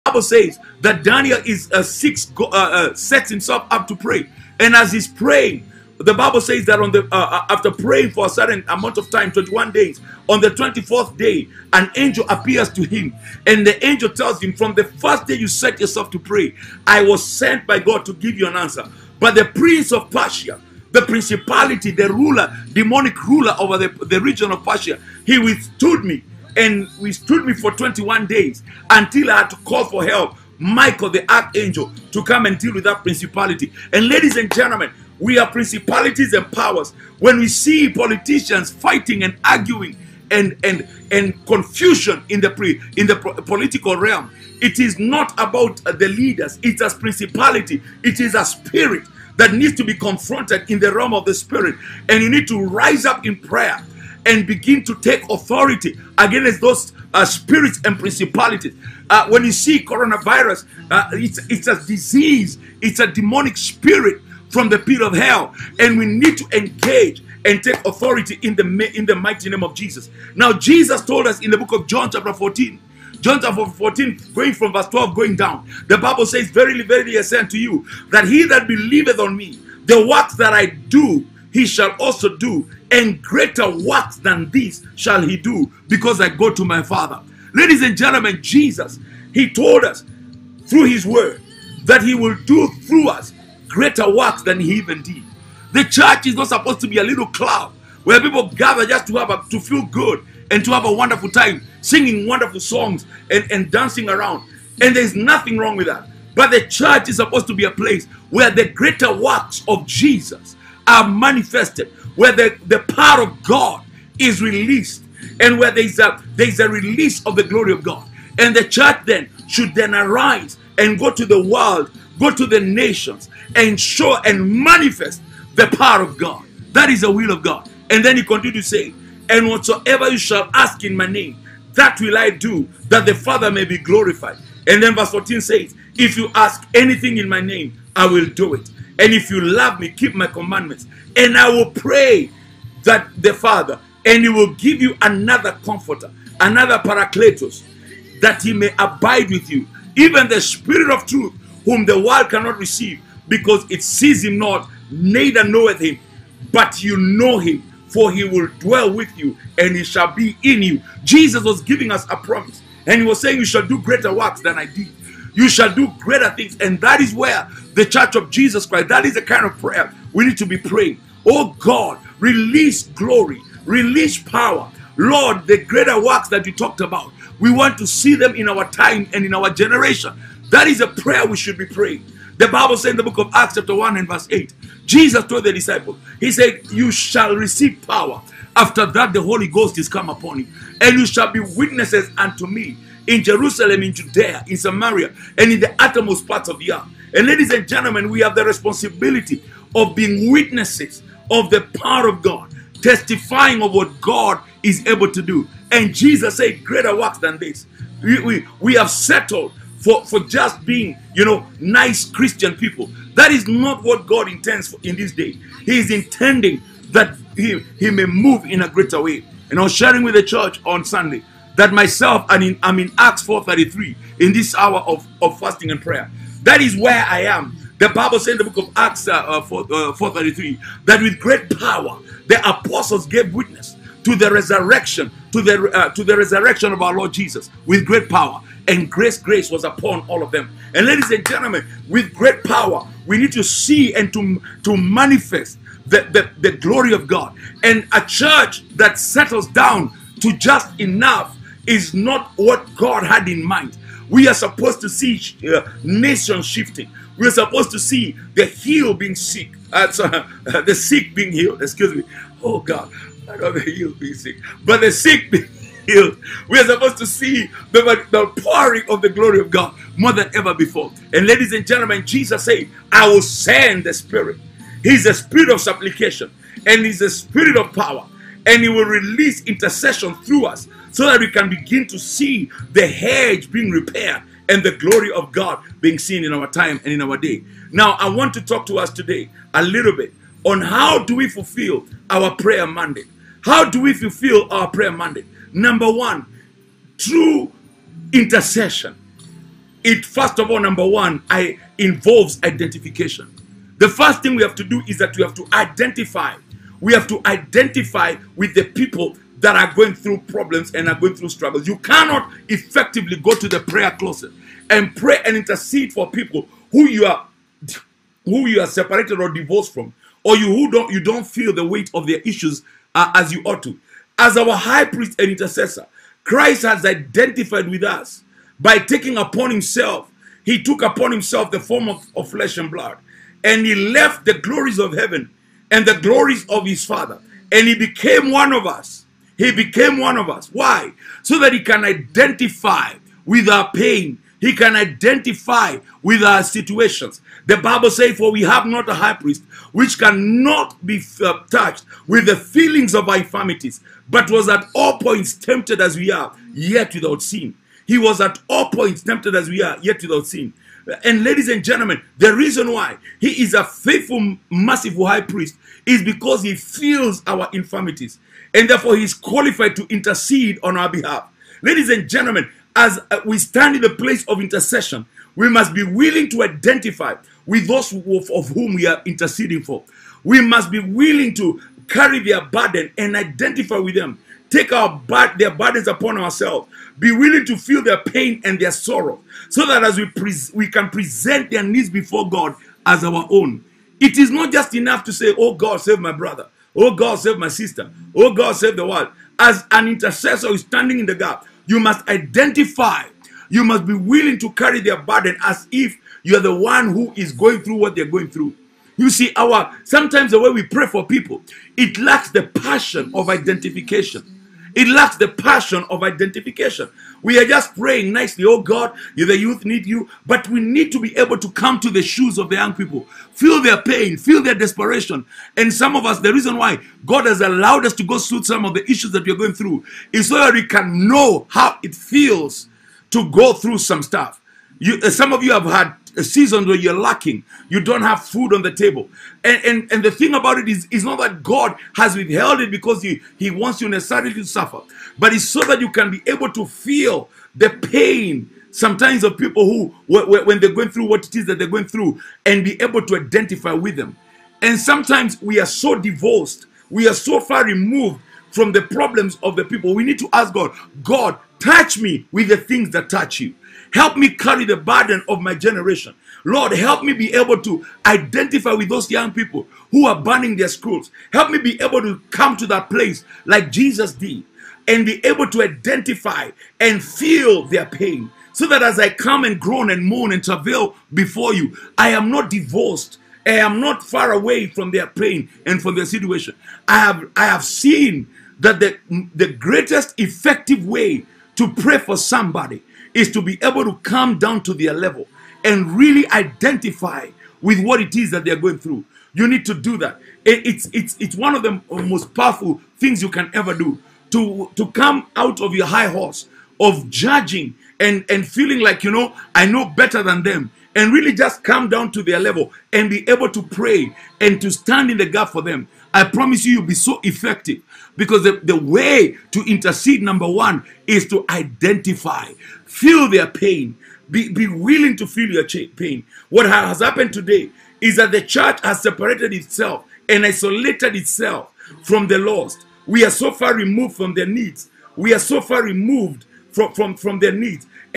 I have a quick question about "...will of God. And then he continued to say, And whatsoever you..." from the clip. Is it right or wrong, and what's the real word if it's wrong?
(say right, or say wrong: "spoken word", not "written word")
right.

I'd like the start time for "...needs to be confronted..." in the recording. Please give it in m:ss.
0:49.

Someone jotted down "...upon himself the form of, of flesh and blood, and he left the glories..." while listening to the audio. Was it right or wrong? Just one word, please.
right.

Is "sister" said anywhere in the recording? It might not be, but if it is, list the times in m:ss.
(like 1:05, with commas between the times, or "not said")
6:37.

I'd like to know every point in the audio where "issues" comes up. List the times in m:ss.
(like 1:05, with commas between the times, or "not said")
5:22, 7:08.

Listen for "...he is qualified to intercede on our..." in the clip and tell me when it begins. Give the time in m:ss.
6:08.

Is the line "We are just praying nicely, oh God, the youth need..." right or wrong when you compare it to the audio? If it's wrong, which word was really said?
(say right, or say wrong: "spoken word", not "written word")
right.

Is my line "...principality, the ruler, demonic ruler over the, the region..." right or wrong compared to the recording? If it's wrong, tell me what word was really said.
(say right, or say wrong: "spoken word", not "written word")
right.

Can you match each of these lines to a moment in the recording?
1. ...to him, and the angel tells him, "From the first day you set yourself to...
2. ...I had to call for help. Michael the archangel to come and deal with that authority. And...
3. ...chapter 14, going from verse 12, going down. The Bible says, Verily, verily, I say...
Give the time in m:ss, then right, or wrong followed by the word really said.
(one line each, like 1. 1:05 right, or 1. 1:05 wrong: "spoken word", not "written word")
1. 0:12 right
2. 0:29 wrong: "principality", not "authority"
3. 1:13 right.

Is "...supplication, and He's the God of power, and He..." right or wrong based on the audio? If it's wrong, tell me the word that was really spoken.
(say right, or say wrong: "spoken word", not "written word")
wrong: "Spirit", not "God".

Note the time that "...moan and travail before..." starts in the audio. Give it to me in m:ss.
8:00.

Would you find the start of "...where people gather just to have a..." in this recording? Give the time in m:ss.
1:38.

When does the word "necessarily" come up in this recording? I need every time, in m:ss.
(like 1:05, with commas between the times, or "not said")
7:23.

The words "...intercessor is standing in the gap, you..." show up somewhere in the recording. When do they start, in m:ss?
6:39.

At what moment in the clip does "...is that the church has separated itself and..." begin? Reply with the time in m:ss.
8:48.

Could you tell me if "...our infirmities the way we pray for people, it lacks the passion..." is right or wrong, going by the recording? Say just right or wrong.
wrong.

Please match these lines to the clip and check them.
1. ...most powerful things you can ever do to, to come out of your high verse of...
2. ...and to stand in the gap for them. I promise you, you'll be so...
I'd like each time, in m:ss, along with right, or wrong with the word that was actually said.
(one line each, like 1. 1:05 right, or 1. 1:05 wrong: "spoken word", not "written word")
1. 8:21 wrong: "horse", not "verse"
2. 8:34 right.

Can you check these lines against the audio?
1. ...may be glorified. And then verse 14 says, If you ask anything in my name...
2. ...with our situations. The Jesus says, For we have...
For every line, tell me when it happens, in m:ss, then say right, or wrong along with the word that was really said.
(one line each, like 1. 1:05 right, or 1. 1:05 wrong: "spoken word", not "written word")
1. 2:13 right
2. 5:46 wrong: "Bible", not "Jesus".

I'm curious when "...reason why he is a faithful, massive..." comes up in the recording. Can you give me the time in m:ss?
6:02.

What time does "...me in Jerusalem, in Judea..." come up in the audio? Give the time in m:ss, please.
3:12.